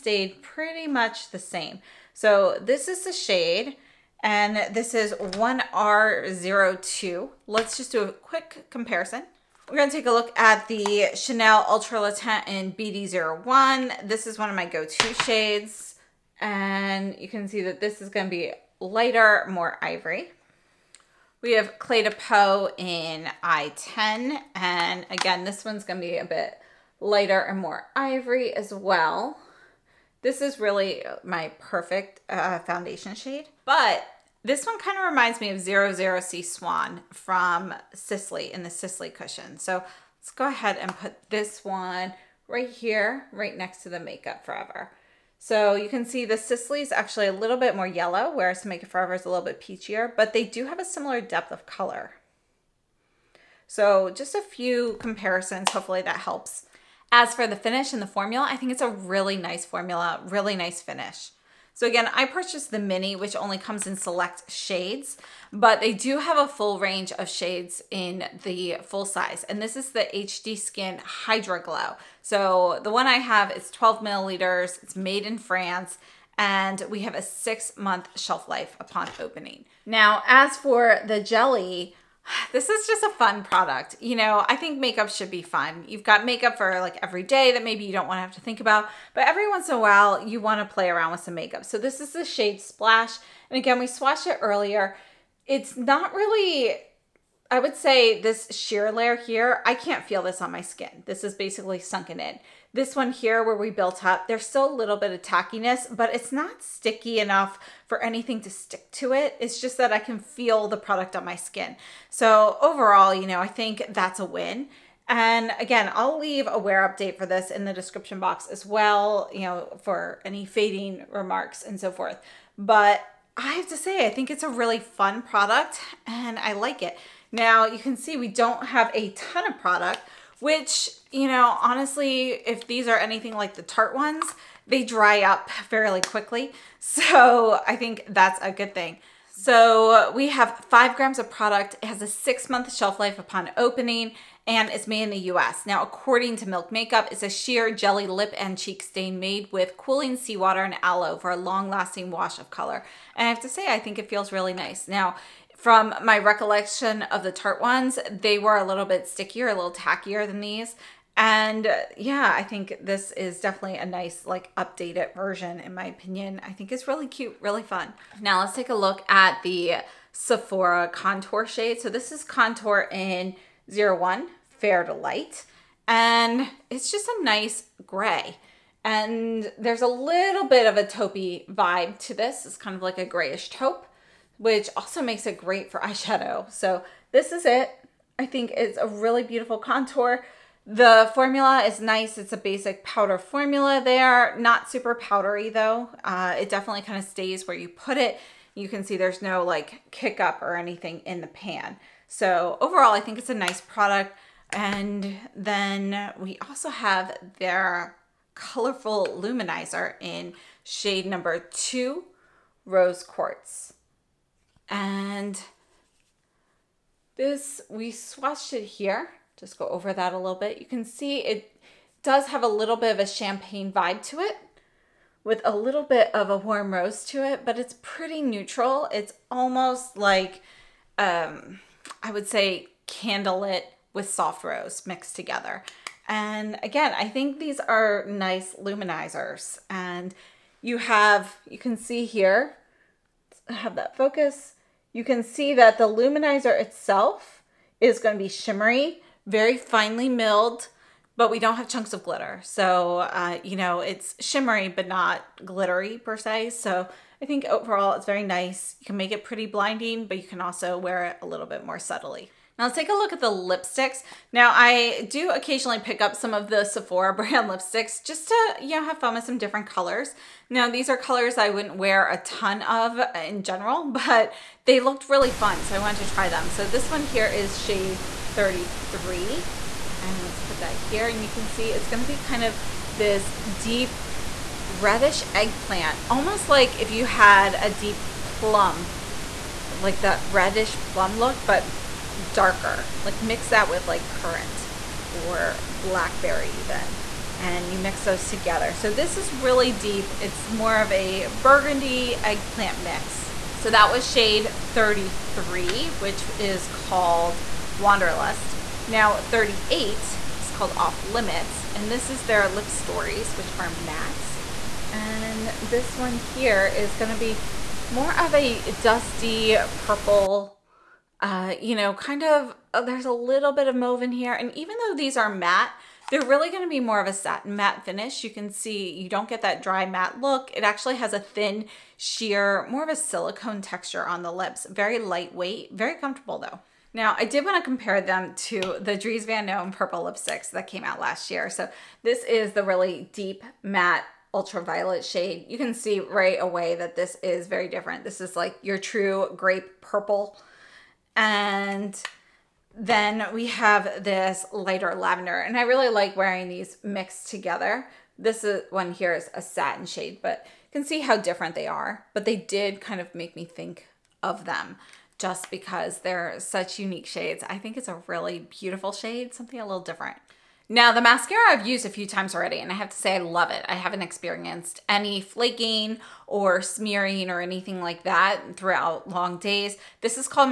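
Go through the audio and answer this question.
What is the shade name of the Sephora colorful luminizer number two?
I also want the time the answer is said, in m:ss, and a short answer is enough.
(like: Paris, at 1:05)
Rose Quartz, at 3:32.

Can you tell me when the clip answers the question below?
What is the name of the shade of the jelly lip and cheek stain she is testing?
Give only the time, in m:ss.
1:32.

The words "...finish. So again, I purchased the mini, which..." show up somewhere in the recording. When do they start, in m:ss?
1:00.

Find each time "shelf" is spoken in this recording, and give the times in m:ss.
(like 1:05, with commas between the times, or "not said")
1:18, 2:22.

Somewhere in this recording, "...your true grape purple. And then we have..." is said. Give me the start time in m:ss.
5:48.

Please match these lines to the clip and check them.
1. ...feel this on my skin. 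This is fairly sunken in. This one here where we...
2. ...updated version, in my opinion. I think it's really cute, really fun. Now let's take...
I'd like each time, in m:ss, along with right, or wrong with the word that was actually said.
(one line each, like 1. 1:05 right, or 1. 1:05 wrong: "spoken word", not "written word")
1. 1:40 wrong: "basically", not "fairly"
2. 2:44 right.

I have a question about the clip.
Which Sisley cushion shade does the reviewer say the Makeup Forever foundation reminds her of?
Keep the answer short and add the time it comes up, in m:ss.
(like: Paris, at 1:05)
00C Swan, at 0:35.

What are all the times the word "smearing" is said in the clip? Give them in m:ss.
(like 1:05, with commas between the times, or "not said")
6:16.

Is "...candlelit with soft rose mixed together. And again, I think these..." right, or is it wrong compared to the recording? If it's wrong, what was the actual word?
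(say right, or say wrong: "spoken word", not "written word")
right.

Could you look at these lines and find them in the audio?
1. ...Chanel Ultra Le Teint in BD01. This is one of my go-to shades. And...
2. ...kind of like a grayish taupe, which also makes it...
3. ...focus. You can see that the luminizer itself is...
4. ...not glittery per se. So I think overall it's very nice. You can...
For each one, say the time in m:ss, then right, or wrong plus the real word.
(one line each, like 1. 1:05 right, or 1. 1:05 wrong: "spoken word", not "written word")
1. 0:11 right
2. 3:02 right
3. 4:03 right
4. 4:14 right.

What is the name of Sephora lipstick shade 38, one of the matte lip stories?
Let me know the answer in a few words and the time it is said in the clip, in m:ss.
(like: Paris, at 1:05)
Off Limits, at 5:10.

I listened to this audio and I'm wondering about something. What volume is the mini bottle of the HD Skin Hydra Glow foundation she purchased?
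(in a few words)
12 milliliters.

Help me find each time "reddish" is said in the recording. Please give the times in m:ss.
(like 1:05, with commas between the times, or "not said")
4:44, 4:50.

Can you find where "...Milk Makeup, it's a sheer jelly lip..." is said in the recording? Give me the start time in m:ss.
2:26.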